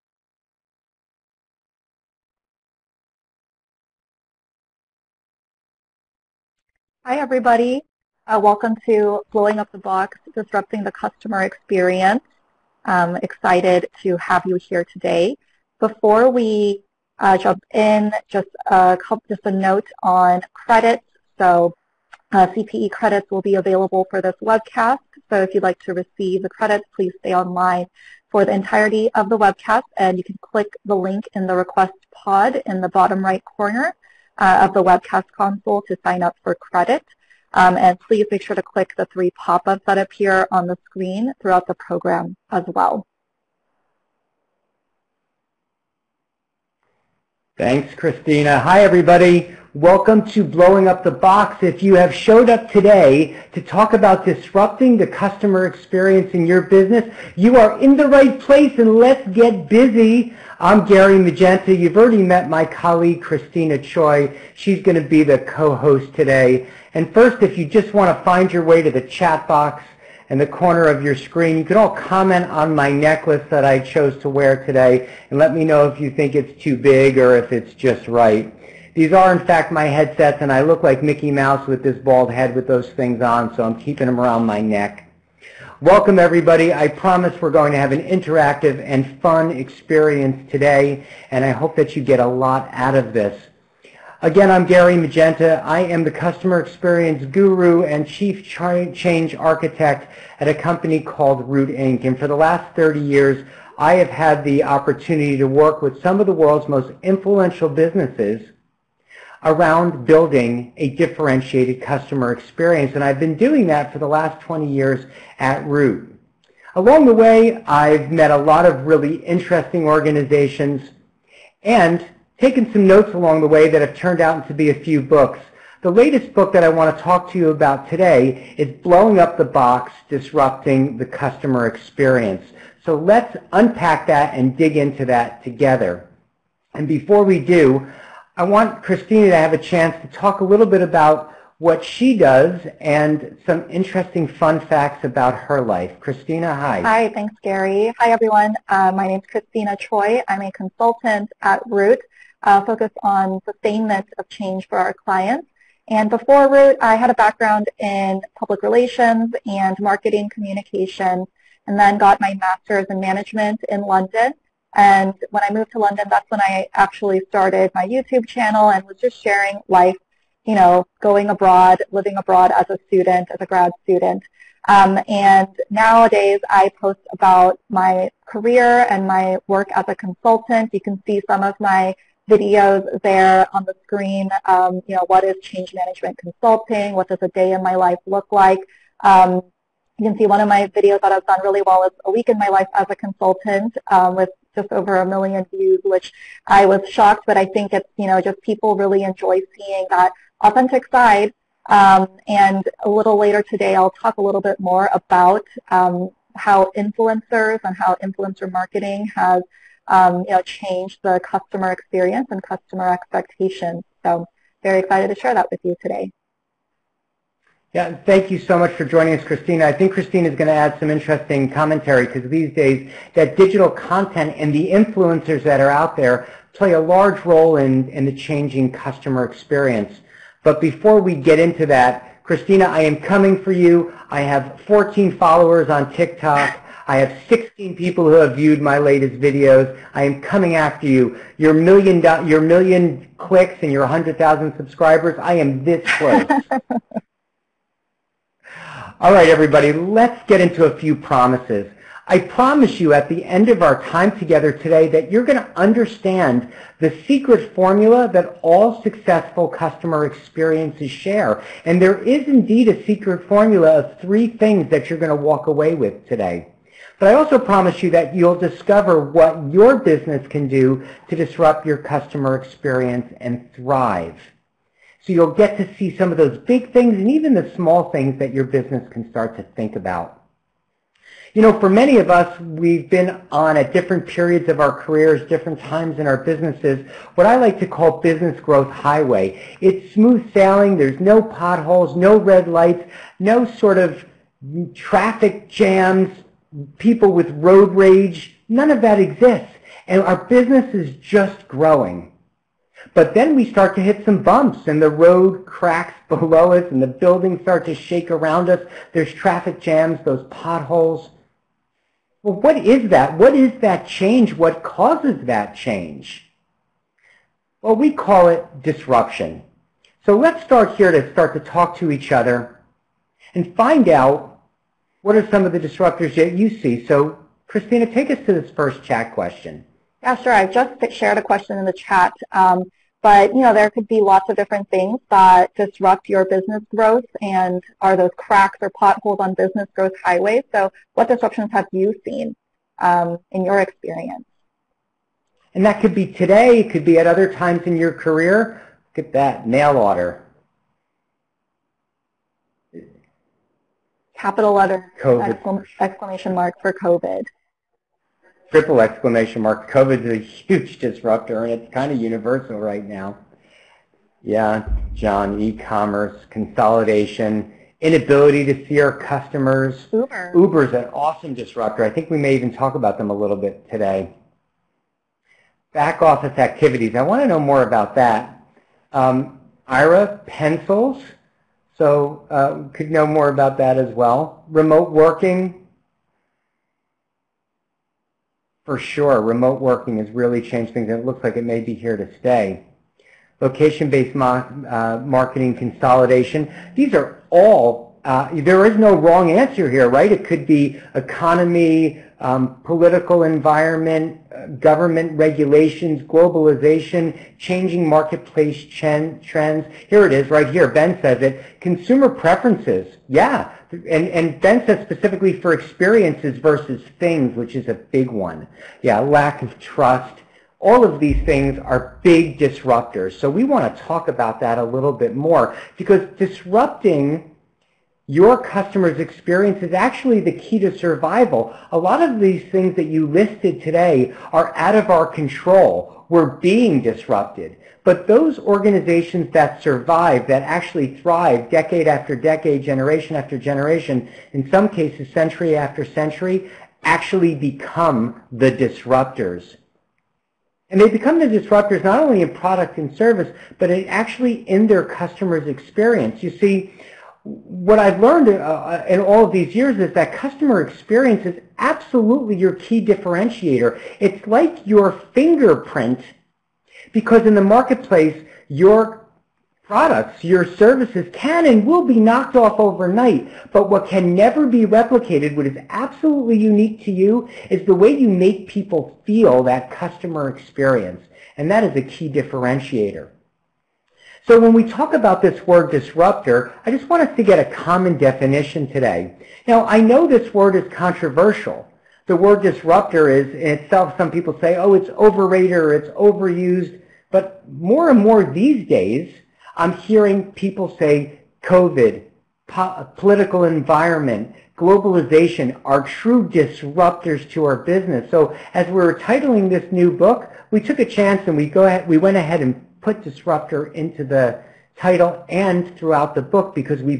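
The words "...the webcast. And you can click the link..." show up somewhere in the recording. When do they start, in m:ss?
0:29.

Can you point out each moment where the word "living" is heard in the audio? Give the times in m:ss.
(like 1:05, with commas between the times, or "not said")
2:51.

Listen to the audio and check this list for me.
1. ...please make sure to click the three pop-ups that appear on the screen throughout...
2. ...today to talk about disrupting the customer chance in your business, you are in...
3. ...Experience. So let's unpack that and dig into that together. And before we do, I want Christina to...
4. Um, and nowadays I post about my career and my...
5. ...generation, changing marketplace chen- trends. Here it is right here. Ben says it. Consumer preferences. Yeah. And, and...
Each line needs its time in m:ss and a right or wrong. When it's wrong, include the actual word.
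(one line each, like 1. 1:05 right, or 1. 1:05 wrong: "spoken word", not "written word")
1. 0:37 right
2. 0:52 wrong: "experience", not "chance"
3. 2:11 right
4. 2:54 right
5. 6:46 wrong: "globalization", not "generation".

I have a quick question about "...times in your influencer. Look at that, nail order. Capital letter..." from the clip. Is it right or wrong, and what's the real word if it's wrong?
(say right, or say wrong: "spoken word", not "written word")
wrong: "career", not "influencer".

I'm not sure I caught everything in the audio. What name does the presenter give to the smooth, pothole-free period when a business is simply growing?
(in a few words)
Business growth highway.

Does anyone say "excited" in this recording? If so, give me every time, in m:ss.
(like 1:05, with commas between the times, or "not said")
0:13, 3:34.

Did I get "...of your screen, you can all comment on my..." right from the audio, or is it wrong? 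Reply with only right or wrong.
right.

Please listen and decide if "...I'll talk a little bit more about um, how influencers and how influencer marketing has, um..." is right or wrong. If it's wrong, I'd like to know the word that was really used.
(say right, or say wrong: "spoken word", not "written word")
right.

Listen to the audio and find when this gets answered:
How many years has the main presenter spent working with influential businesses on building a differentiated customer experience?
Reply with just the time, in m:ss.
1:42.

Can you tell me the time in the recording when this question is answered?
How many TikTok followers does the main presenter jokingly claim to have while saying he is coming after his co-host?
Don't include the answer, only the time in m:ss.
3:54.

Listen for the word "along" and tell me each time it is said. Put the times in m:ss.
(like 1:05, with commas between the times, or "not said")
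1:56, 2:03.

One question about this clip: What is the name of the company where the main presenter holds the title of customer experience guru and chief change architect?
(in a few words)
Root Inc.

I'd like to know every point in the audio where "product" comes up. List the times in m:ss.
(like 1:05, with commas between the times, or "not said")
7:32, 7:49.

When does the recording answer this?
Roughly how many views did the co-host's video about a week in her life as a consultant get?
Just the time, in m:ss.
3:14.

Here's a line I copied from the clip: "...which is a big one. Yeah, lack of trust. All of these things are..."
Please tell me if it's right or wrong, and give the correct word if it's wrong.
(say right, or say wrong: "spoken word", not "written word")
right.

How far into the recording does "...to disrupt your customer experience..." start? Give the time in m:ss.
4:31.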